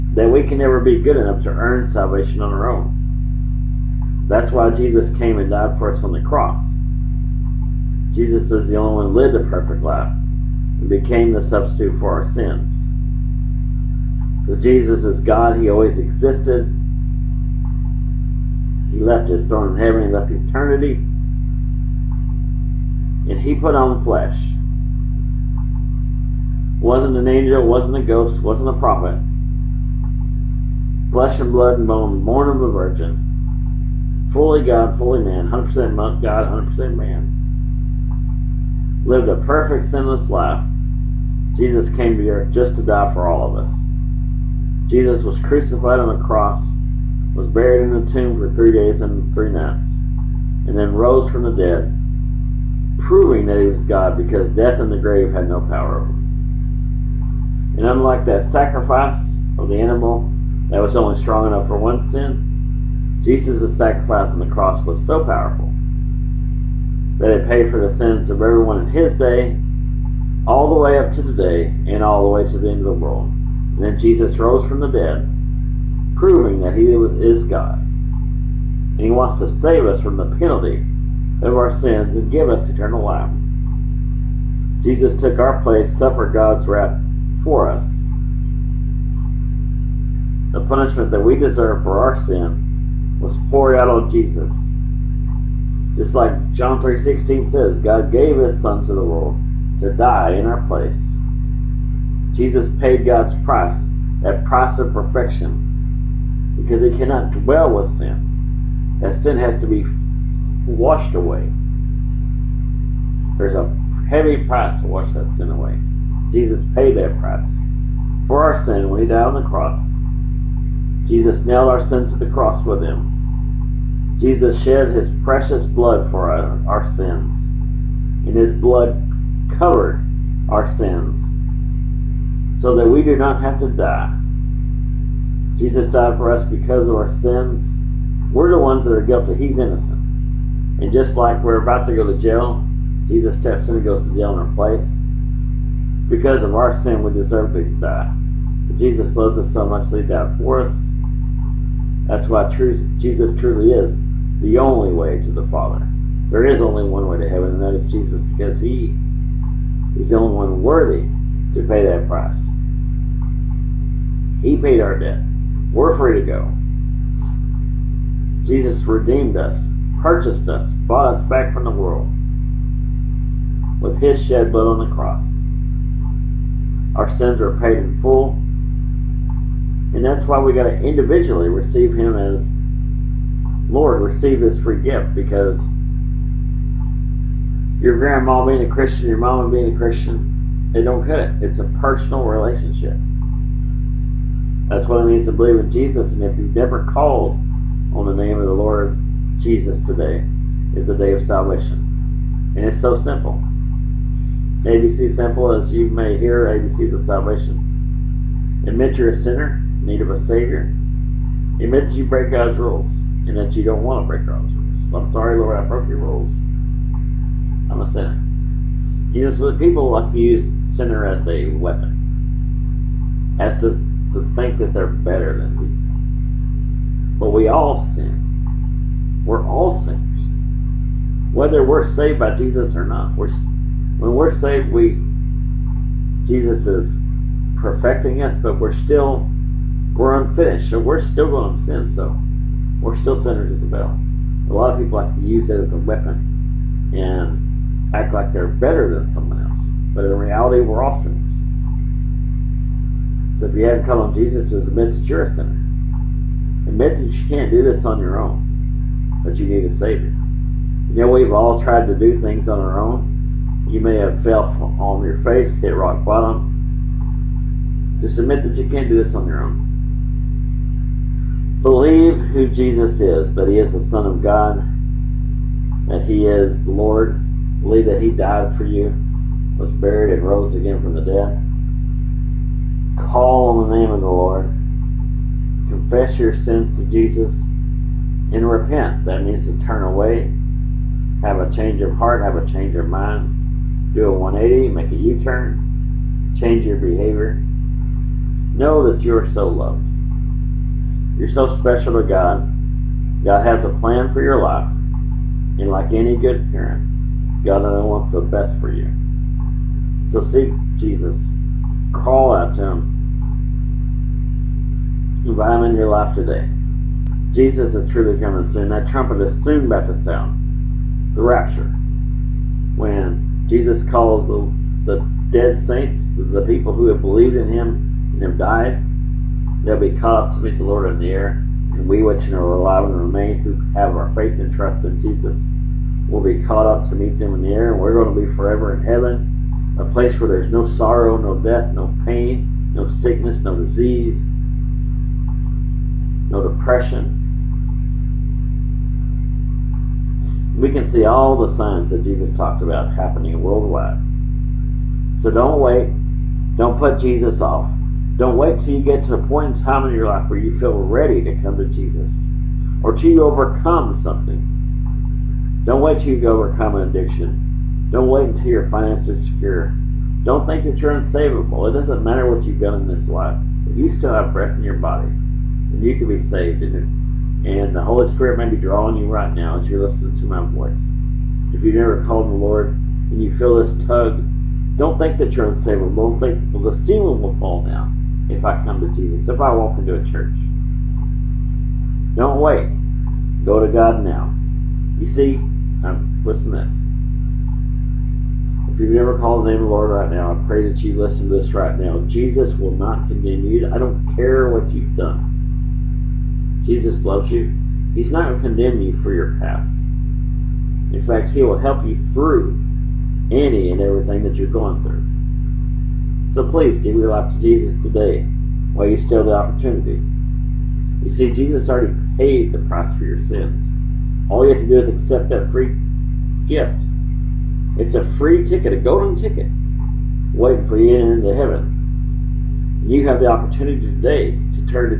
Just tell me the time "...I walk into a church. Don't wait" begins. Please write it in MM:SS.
06:29.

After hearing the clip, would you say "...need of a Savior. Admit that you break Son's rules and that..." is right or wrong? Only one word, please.
wrong.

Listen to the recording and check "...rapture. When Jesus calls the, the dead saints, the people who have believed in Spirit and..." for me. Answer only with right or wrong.
wrong.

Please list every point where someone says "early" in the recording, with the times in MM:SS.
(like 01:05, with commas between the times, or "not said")
not said.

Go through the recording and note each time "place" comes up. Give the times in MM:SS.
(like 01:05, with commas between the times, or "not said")
01:25, 01:40, 02:24, 05:39.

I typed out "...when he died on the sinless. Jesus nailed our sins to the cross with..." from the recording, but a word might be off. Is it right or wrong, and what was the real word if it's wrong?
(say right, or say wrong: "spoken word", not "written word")
wrong: "cross", not "sinless".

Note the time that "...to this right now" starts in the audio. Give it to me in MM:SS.
06:41.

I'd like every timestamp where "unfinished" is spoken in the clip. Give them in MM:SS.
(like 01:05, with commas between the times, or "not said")
04:00.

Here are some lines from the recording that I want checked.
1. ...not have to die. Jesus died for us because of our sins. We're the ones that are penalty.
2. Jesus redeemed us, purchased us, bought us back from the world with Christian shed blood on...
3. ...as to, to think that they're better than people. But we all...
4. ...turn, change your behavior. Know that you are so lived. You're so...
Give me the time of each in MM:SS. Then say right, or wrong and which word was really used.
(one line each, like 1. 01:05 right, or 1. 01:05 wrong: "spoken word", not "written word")
1. 02:13 wrong: "guilty", not "penalty"
2. 02:48 wrong: "His", not "Christian"
3. 03:43 right
4. 04:55 wrong: "loved", not "lived".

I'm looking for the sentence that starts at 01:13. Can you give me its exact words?
And then Jesus rose from the dead, proving that he is God.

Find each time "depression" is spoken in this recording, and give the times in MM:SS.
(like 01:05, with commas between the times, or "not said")
05:46.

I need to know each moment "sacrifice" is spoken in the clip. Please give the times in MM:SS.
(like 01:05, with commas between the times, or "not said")
00:58, 01:03.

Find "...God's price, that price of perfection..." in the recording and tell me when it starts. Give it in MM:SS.
01:43.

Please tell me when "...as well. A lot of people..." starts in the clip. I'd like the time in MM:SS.
04:03.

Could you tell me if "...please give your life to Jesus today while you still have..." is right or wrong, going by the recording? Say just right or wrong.
right.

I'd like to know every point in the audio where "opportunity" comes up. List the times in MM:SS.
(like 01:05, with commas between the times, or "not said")
06:59, 07:13.